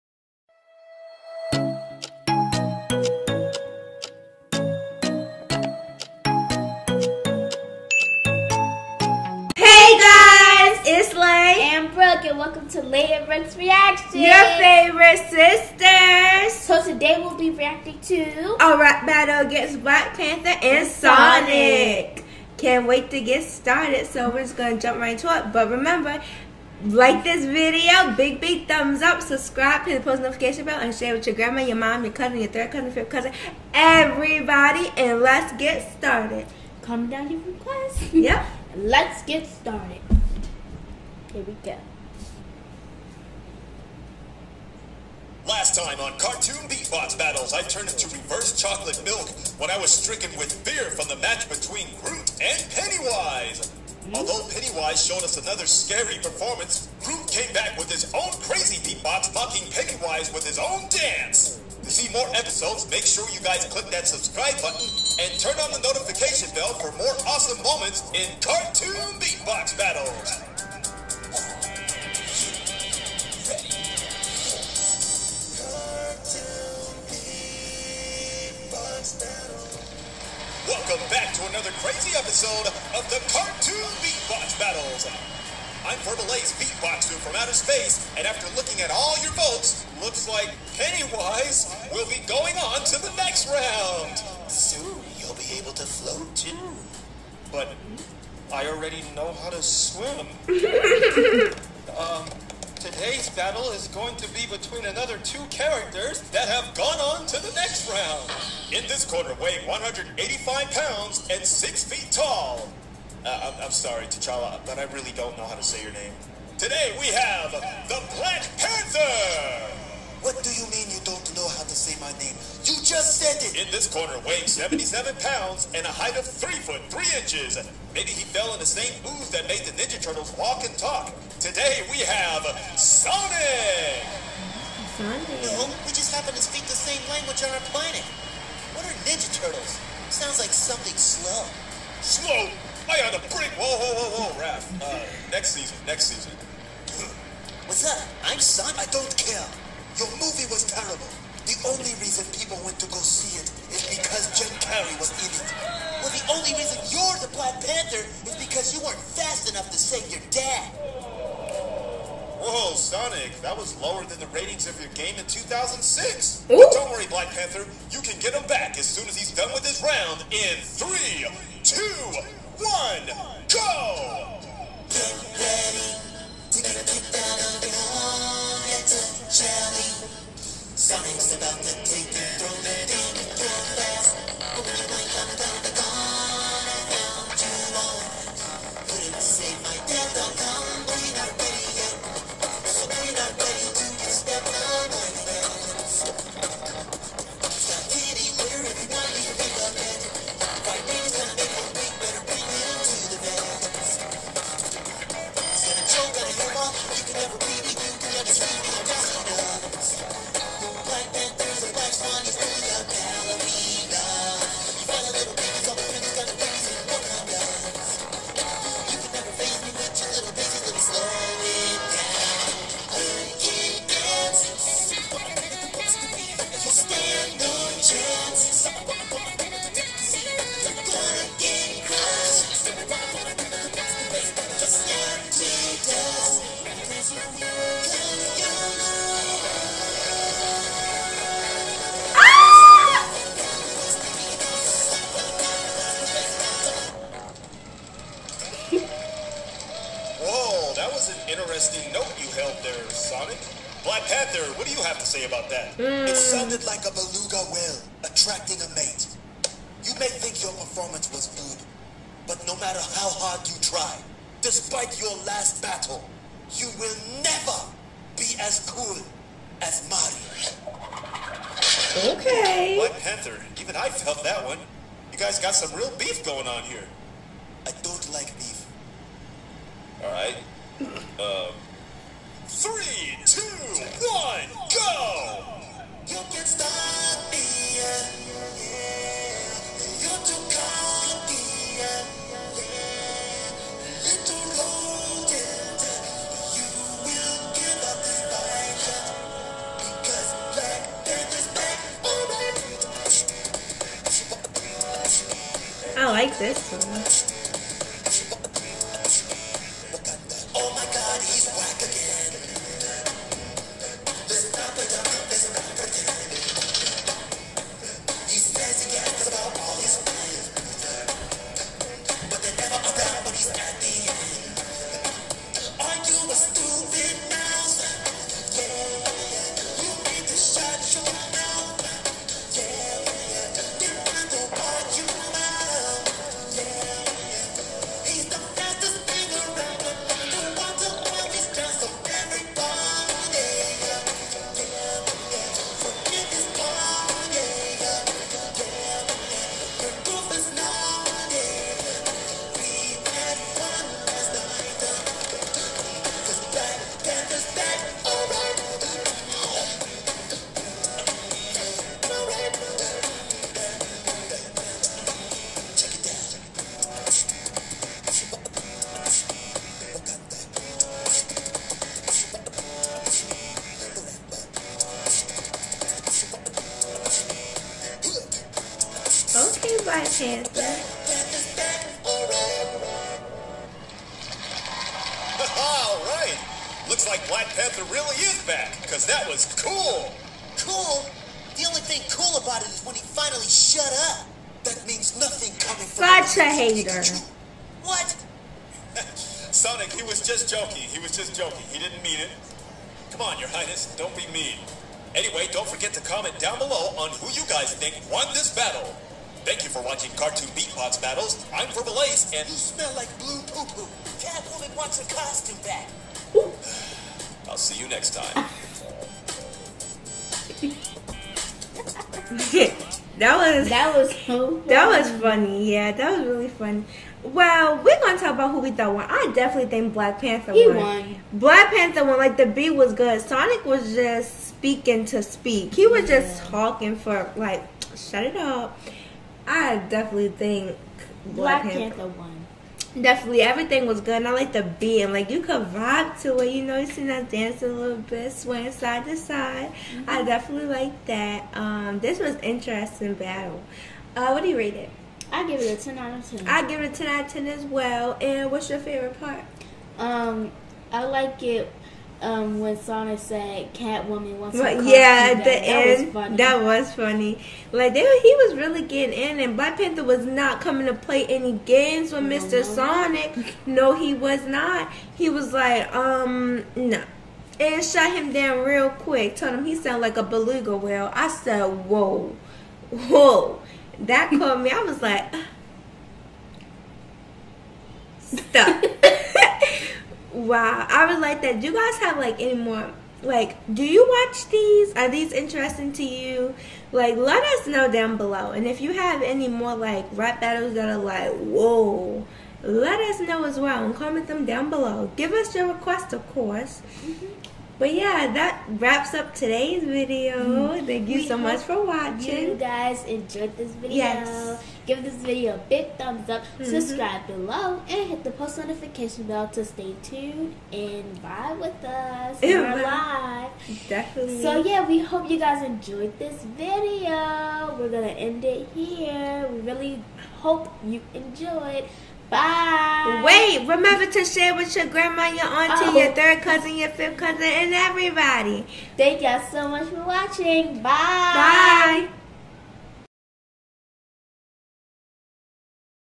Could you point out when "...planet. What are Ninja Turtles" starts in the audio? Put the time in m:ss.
2:17.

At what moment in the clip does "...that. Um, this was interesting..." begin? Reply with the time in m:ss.
7:31.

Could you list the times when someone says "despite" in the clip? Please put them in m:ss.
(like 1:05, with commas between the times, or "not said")
4:24.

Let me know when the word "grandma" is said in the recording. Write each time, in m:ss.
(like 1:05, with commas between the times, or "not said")
0:31, 8:54.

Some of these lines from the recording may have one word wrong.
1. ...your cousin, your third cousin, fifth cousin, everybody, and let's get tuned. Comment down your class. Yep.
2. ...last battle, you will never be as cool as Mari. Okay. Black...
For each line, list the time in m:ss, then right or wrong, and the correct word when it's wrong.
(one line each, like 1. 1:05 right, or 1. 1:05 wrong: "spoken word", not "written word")
1. 0:32 wrong: "started", not "tuned"
2. 4:25 right.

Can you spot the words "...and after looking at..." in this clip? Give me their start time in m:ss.
1:28.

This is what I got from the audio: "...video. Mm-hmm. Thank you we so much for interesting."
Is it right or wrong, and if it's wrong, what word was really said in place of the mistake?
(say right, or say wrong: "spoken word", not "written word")
wrong: "watching", not "interesting".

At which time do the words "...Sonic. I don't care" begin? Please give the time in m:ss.
2:28.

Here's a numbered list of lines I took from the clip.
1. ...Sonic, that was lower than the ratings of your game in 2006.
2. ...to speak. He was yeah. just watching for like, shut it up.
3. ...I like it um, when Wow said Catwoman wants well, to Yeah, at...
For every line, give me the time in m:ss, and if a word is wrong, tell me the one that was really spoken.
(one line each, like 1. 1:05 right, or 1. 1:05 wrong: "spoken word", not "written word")
1. 2:42 right
2. 7:15 wrong: "talking", not "watching"
3. 7:40 wrong: "Sana", not "Wow".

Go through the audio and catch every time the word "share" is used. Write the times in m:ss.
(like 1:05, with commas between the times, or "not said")
0:30, 8:54.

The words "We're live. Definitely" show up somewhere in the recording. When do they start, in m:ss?
8:42.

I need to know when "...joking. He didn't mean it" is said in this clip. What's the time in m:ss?
6:41.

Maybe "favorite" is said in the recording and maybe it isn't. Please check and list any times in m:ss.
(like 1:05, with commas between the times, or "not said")
0:14, 7:38.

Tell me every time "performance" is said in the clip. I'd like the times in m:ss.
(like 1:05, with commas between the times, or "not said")
0:56, 4:20.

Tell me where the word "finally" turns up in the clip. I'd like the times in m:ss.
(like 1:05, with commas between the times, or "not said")
6:33.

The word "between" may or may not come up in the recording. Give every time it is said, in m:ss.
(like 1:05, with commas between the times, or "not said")
0:51, 1:44.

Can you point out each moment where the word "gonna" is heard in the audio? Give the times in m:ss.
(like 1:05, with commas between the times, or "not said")
0:24, 7:07, 8:47.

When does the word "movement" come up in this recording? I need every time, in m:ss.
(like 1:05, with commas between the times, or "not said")
not said.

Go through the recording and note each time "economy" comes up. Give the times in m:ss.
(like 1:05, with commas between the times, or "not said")
not said.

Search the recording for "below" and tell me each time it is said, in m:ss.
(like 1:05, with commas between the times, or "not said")
6:46, 8:18, 8:24, 8:37.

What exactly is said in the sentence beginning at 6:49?
Thank you for watching Cartoon Beatbox Battles.